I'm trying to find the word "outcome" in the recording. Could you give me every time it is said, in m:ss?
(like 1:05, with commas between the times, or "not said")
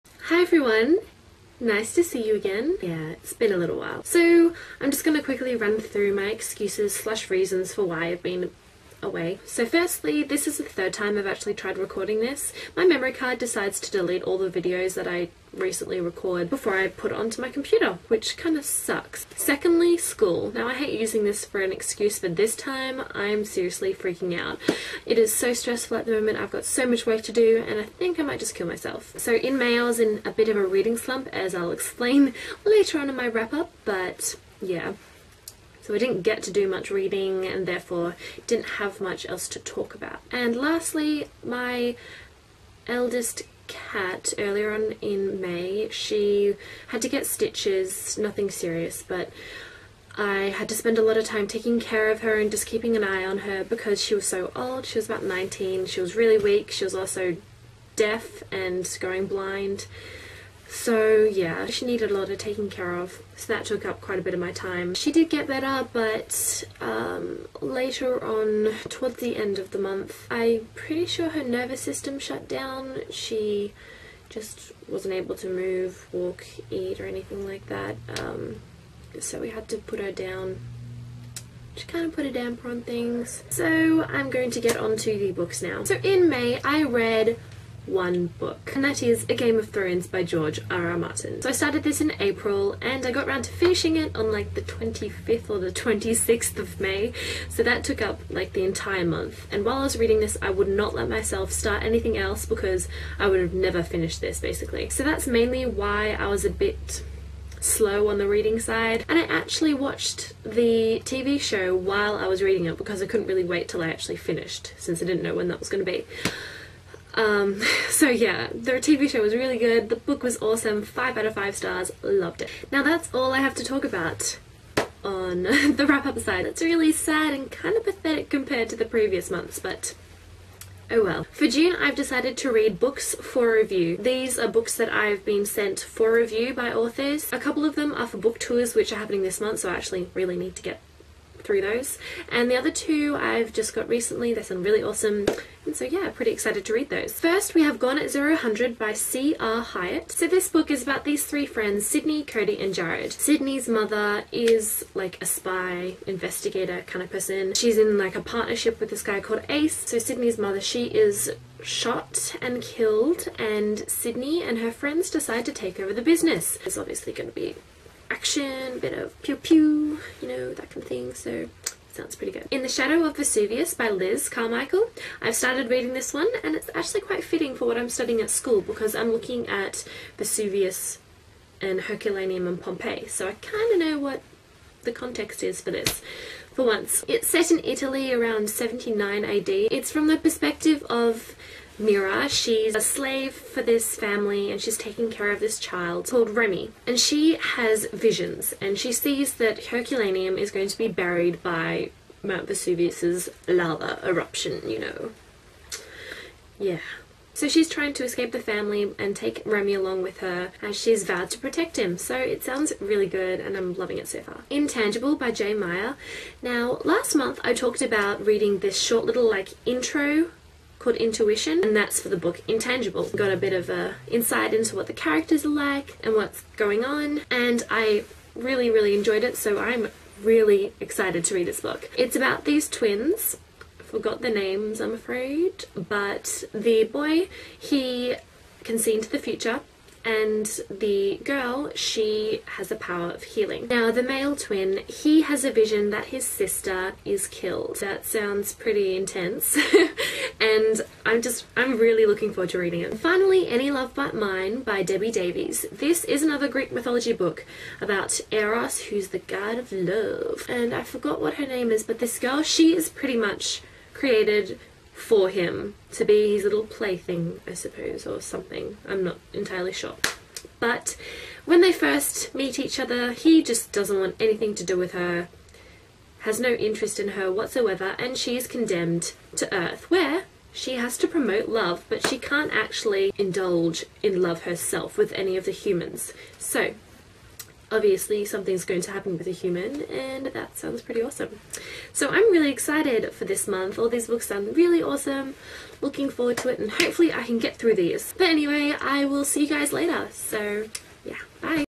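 not said.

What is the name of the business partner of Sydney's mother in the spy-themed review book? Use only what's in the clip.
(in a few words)
Ace.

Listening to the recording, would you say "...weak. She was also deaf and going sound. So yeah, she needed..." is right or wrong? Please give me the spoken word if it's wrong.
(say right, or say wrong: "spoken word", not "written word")
wrong: "blind", not "sound".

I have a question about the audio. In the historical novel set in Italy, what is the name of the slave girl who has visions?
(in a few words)
Mira.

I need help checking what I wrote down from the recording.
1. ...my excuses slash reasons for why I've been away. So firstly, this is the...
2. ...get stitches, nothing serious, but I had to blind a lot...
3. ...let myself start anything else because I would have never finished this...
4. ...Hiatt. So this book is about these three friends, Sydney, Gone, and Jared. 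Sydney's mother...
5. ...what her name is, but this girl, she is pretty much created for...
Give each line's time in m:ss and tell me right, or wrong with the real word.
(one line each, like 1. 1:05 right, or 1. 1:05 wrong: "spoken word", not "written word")
1. 0:06 right
2. 0:47 wrong: "spend", not "blind"
3. 1:40 right
4. 2:29 wrong: "Cody", not "Gone"
5. 4:21 right.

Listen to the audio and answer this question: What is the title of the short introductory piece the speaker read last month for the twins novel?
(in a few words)
Intuition.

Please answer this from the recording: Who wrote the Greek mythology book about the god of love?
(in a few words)
Debbie Davies.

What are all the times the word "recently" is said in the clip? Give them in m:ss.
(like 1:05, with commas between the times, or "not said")
0:15, 2:23.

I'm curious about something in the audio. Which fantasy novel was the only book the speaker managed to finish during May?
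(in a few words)
A Game of Thrones.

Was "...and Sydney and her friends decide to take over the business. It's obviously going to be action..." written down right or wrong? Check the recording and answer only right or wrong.
right.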